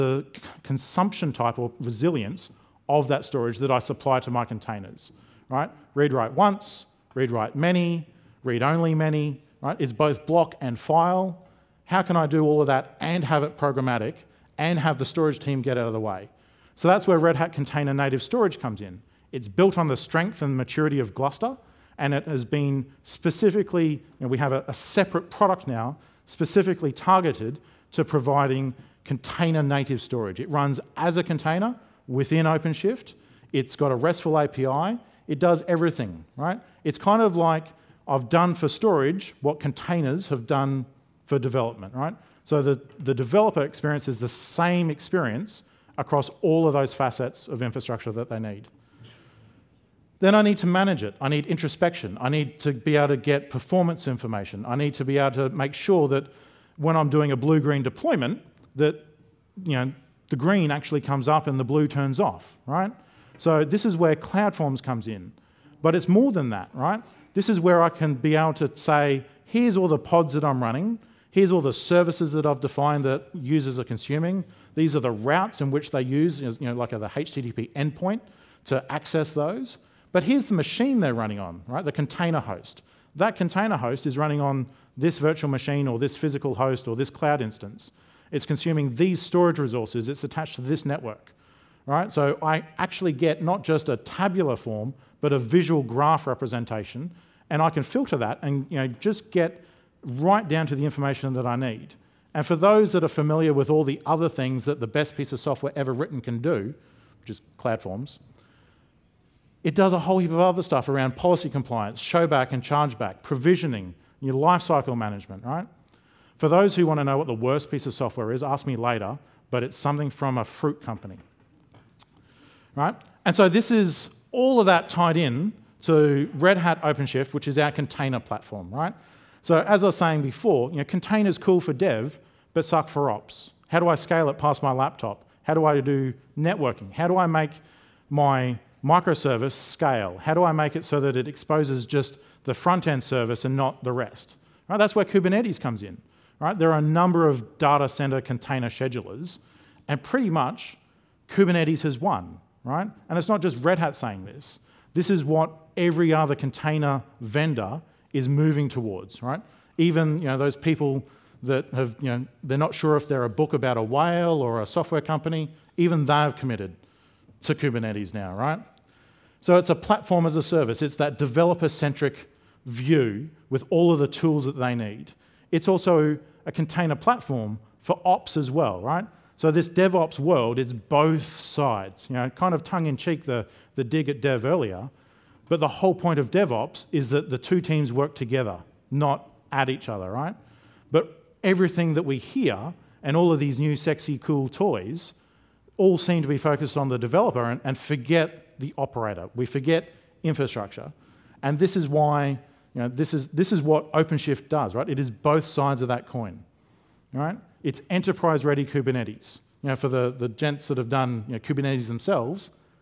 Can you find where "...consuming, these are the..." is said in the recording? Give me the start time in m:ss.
1:13.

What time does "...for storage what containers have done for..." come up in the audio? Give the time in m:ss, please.
0:38.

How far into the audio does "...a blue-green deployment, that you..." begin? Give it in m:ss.
0:57.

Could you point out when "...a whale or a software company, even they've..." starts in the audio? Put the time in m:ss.
2:43.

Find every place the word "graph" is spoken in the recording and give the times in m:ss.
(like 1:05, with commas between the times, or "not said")
1:35.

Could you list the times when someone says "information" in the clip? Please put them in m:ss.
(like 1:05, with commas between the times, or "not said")
0:54, 1:40.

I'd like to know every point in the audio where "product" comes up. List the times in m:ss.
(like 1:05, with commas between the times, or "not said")
0:25.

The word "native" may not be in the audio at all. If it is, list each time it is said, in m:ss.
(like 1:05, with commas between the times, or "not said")
0:17, 0:29.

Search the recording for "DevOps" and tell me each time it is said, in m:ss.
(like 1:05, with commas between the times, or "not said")
2:59, 3:06.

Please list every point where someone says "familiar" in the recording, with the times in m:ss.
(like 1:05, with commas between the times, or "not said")
1:43.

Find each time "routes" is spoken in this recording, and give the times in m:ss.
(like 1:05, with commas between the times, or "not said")
1:15.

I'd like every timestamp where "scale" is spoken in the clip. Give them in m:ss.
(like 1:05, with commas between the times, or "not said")
2:13, 2:19.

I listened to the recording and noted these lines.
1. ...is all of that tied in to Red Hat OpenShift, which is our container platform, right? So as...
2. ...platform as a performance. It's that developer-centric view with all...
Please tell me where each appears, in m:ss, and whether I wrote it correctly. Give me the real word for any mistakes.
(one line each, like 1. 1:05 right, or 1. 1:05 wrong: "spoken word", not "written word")
1. 2:03 right
2. 2:49 wrong: "service", not "performance".